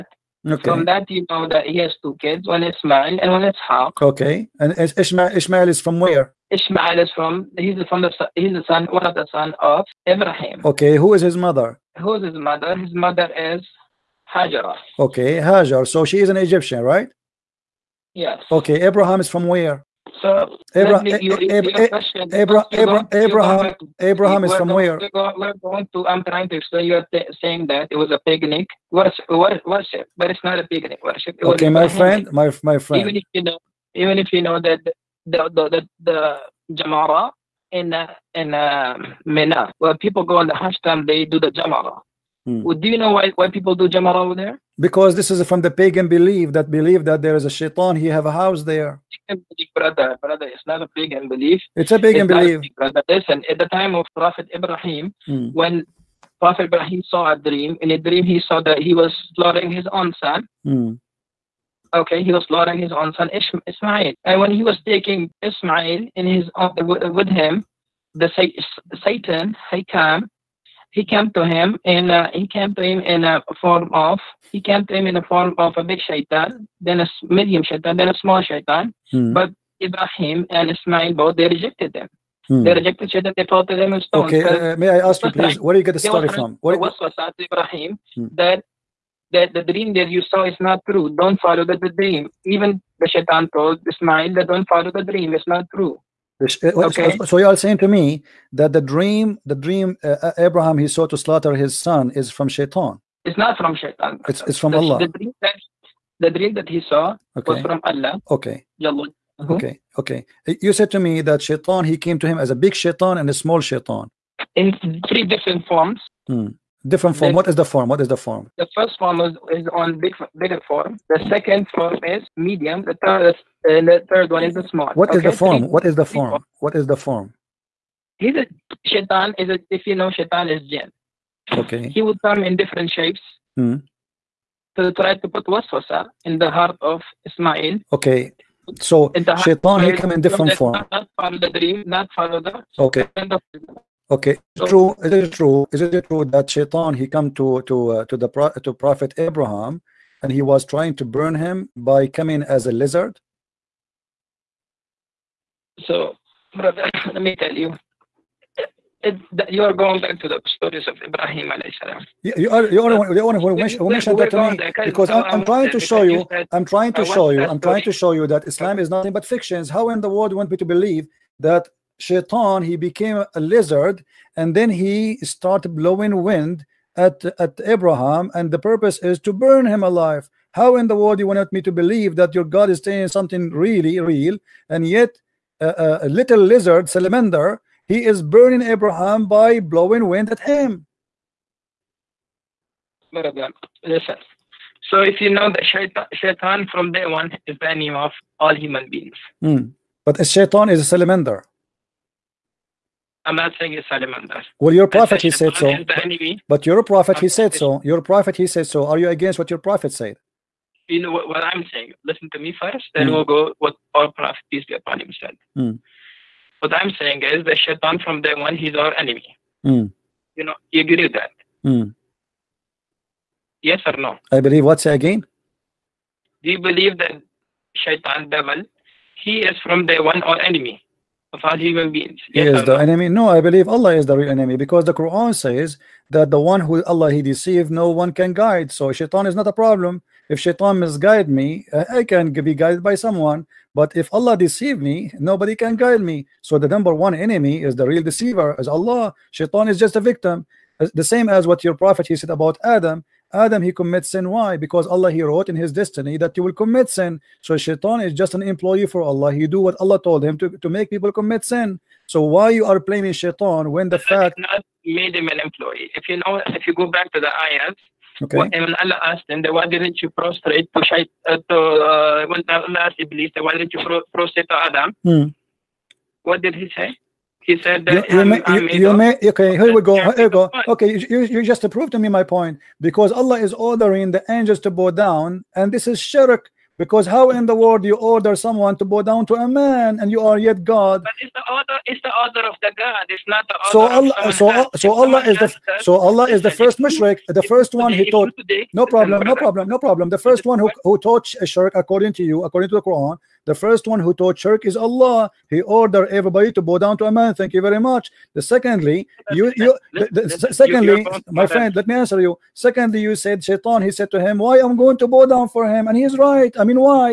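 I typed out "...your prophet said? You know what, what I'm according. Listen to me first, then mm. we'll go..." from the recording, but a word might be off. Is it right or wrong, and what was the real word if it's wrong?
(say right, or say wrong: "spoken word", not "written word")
wrong: "saying", not "according".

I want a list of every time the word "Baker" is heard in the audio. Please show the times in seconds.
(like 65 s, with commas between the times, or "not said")
not said.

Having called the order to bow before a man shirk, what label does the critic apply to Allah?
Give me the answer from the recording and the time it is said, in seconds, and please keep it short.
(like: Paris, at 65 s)
the first mushrik, at 296 s.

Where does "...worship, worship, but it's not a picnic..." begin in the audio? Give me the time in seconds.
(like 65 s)
28 s.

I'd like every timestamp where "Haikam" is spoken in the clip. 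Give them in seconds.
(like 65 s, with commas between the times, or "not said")
69 s.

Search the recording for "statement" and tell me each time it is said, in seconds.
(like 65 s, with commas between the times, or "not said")
not said.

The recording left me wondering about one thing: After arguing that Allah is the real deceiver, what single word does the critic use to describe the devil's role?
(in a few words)
victim.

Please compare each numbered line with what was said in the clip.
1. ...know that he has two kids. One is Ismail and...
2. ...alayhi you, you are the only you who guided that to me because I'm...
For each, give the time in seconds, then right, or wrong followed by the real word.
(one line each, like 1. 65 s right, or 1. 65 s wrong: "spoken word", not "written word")
1. 1 s right
2. 161 s wrong: "mentioned", not "guided".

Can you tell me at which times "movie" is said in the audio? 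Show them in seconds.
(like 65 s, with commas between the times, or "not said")
not said.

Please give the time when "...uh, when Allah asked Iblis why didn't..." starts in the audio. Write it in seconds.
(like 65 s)
271 s.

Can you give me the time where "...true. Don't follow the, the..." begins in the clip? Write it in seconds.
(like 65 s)
90 s.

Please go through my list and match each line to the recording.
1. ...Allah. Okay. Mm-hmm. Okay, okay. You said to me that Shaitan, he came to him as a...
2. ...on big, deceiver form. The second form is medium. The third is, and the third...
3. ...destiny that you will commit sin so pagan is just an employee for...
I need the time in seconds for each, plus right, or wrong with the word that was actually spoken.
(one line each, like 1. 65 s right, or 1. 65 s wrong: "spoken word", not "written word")
1. 107 s right
2. 119 s wrong: "bigger", not "deceiver"
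3. 255 s wrong: "shaitan", not "pagan".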